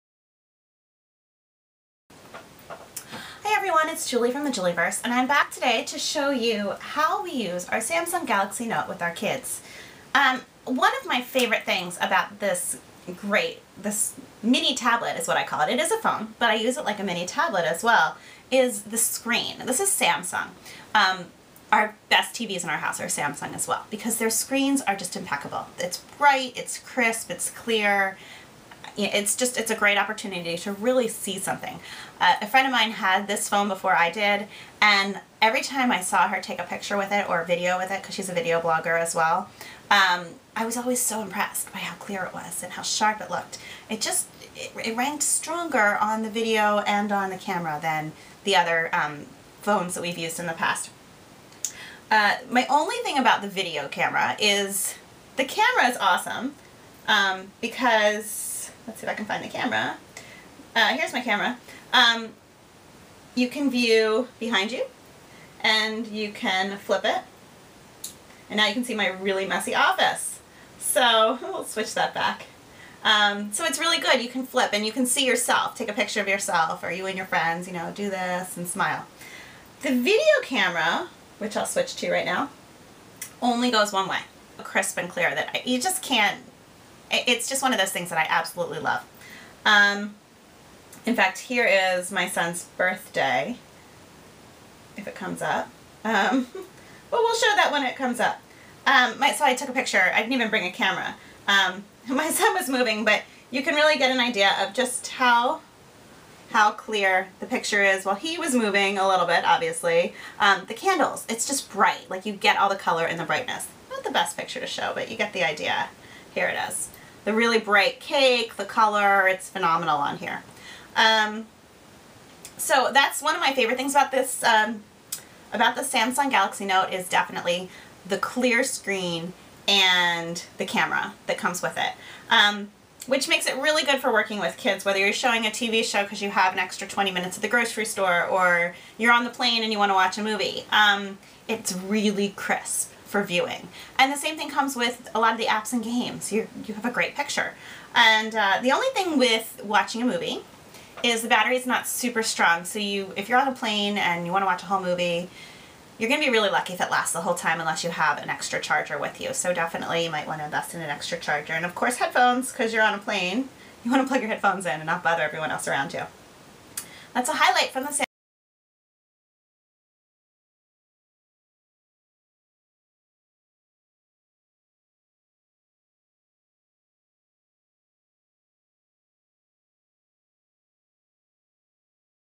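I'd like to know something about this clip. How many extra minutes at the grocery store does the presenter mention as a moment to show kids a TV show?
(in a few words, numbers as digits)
20.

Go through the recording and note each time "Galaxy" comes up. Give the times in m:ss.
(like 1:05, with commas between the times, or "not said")
0:08, 2:06.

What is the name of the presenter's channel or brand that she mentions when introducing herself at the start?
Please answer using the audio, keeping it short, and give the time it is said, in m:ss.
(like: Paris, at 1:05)
the Julieverse, at 0:04.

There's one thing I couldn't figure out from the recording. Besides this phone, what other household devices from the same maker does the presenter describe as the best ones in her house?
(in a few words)
TVs.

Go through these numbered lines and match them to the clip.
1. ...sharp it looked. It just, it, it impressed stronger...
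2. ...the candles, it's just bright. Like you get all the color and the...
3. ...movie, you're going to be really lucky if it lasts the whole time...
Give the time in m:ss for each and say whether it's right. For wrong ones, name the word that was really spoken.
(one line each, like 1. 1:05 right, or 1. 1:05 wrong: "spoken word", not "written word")
1. 0:42 wrong: "ranked", not "impressed"
2. 1:50 right
3. 2:34 right.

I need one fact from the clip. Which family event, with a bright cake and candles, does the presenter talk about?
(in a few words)
son's birthday.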